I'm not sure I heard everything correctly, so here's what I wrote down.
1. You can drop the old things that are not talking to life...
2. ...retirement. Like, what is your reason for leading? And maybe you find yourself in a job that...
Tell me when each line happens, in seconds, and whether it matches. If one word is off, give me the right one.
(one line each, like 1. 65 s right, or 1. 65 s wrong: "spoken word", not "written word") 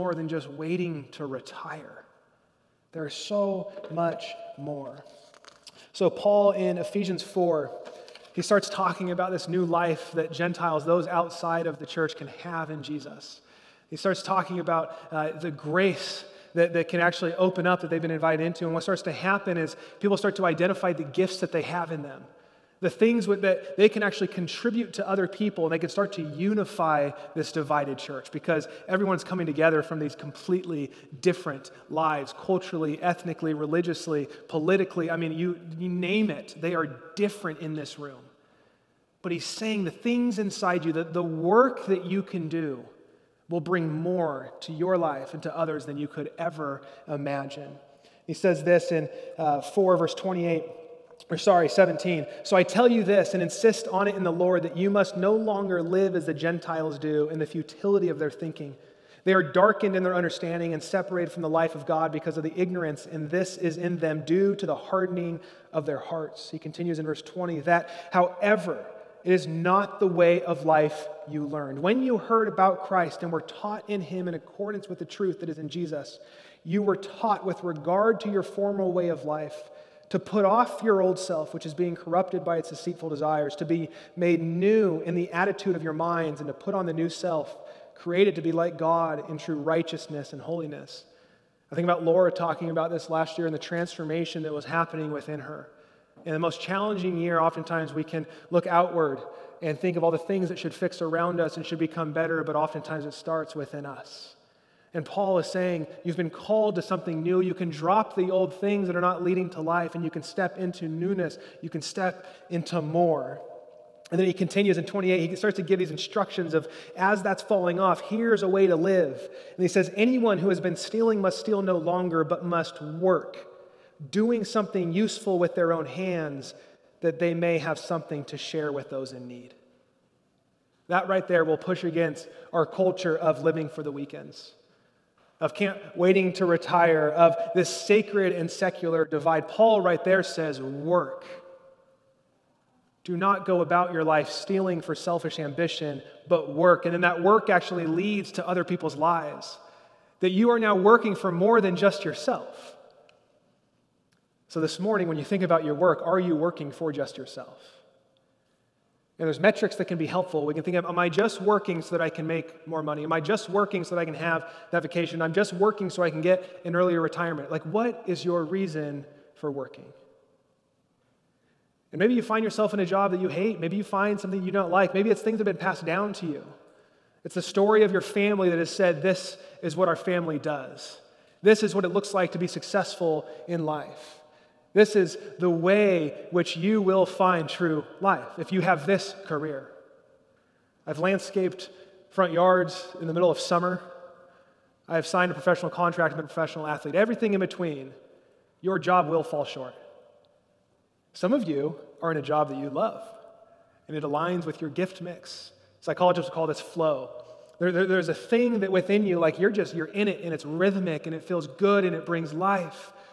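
1. 107 s wrong: "leading", not "talking"
2. 166 s wrong: "working", not "leading".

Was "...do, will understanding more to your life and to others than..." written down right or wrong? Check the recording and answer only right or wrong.
wrong.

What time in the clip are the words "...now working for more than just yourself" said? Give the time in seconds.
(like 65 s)
150 s.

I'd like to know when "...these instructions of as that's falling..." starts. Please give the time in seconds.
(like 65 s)
115 s.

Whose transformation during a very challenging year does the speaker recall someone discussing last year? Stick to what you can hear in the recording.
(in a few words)
Laura.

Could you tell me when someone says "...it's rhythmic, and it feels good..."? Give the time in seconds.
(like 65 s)
210 s.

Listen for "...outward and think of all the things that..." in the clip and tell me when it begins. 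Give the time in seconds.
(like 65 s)
98 s.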